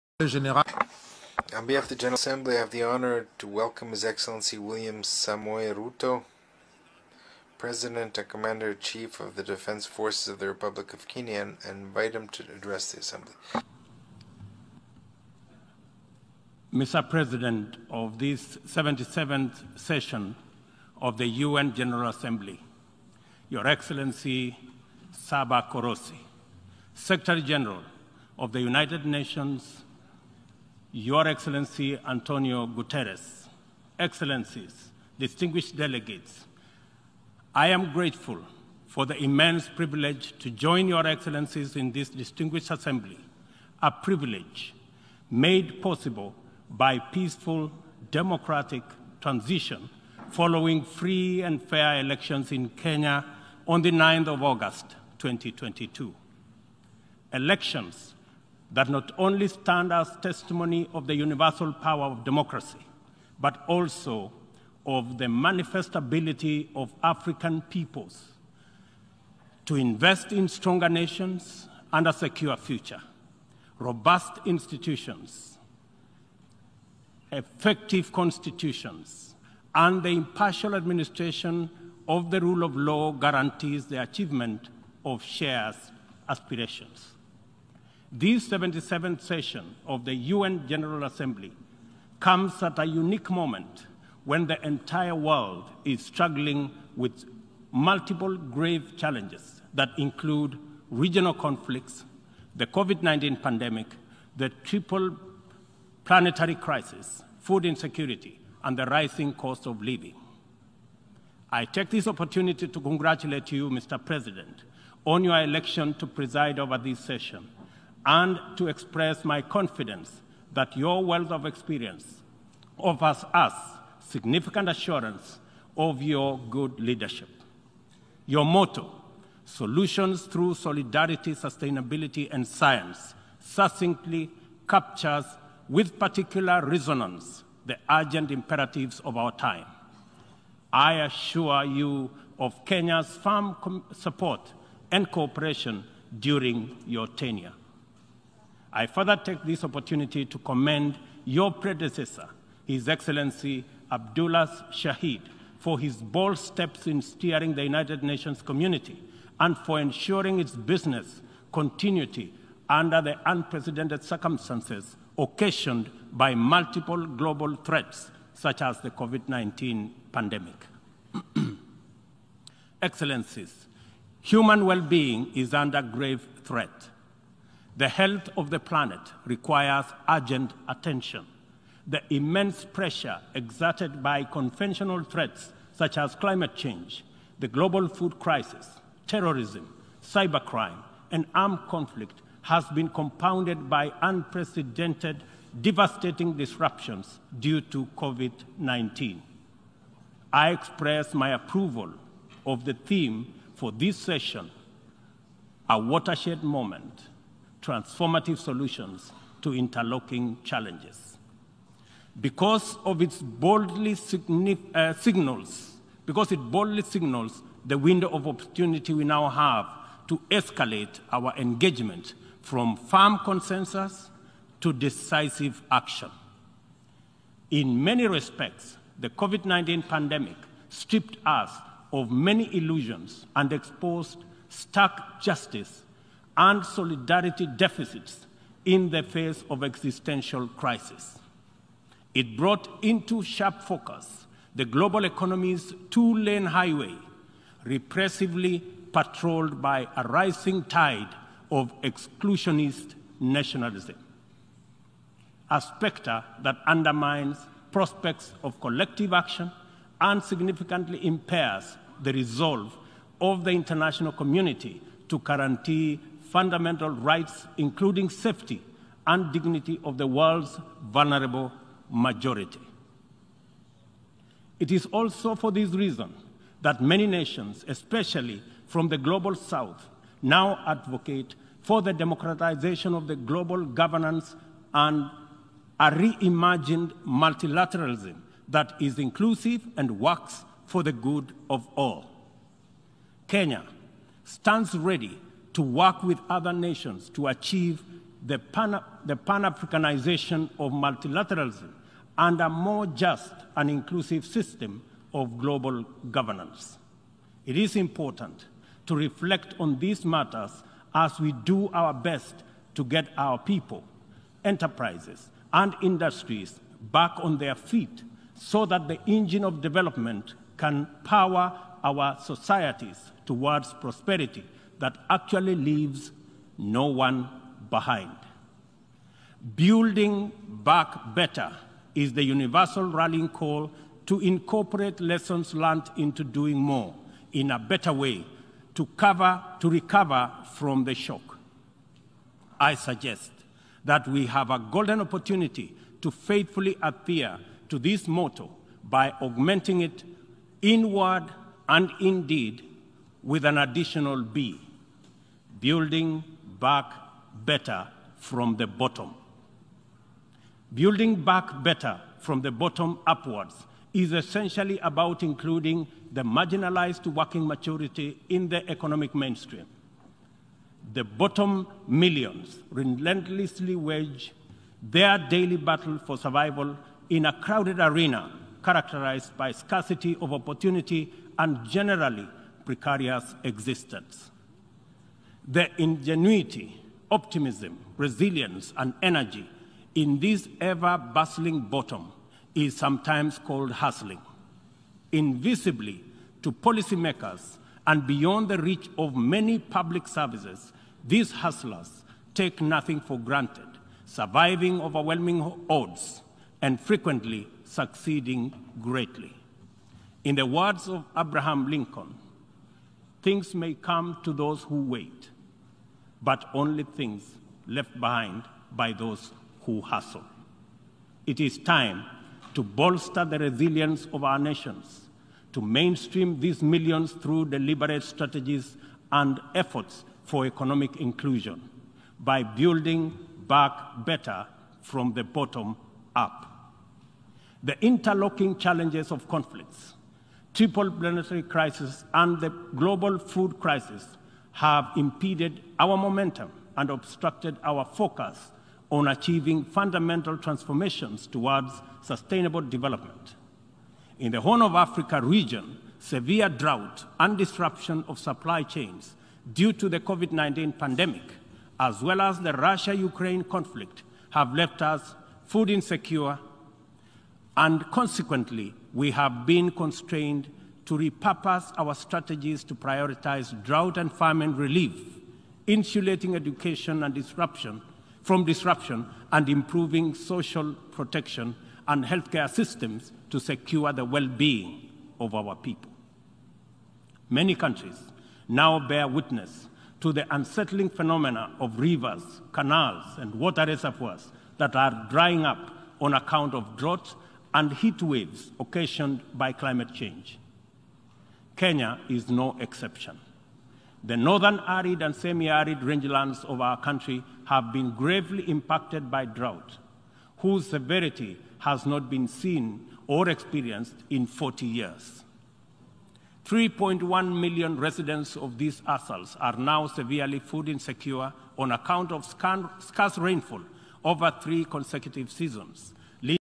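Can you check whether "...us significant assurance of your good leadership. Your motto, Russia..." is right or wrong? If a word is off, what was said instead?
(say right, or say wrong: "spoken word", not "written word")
wrong: "Solutions", not "Russia".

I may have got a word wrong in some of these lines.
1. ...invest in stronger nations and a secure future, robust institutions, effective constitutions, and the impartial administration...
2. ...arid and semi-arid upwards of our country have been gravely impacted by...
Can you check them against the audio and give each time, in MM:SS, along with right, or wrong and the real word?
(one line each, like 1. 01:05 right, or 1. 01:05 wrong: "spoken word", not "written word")
1. 01:09 right
2. 08:24 wrong: "rangelands", not "upwards".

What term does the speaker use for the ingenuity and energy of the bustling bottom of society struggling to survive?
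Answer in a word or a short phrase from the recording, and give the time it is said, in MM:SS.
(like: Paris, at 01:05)
hustling, at 06:33.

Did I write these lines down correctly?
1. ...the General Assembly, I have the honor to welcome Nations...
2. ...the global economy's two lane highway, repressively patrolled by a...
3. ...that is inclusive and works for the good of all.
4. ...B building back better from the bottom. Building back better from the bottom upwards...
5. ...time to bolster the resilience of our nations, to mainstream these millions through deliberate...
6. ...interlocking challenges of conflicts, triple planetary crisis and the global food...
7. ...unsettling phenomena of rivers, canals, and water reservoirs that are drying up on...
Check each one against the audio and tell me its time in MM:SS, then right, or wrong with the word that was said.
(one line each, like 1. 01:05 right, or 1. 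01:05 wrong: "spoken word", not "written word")
1. 00:01 wrong: "His", not "Nations"
2. 04:04 right
3. 04:48 right
4. 05:54 right
5. 07:01 right
6. 07:17 right
7. 08:10 right.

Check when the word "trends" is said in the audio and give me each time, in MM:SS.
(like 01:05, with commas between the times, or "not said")
not said.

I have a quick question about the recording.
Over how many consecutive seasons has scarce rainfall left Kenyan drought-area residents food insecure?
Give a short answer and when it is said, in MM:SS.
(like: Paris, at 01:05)
three, at 08:44.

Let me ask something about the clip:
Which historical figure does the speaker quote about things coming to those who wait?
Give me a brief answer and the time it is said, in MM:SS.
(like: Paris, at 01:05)
Abraham Lincoln, at 06:51.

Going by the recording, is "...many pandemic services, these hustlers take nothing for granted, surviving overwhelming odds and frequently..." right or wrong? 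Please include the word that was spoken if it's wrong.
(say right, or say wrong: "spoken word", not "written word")
wrong: "public", not "pandemic".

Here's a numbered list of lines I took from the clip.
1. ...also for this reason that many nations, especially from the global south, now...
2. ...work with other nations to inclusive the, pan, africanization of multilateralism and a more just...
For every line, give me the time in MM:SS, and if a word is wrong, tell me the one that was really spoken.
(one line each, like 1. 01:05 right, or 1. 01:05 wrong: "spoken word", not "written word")
1. 04:34 right
2. 04:55 wrong: "achieve", not "inclusive".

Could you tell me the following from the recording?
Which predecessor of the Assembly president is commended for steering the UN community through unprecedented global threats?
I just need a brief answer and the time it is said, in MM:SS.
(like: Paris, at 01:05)
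Abdullah Shahid, at 02:33.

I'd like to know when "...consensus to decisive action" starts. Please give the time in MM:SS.
03:43.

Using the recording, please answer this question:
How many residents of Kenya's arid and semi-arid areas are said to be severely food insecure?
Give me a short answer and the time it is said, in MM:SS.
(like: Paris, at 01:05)
3.1 million, at 08:36.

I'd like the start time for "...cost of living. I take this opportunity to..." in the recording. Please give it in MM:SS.
01:49.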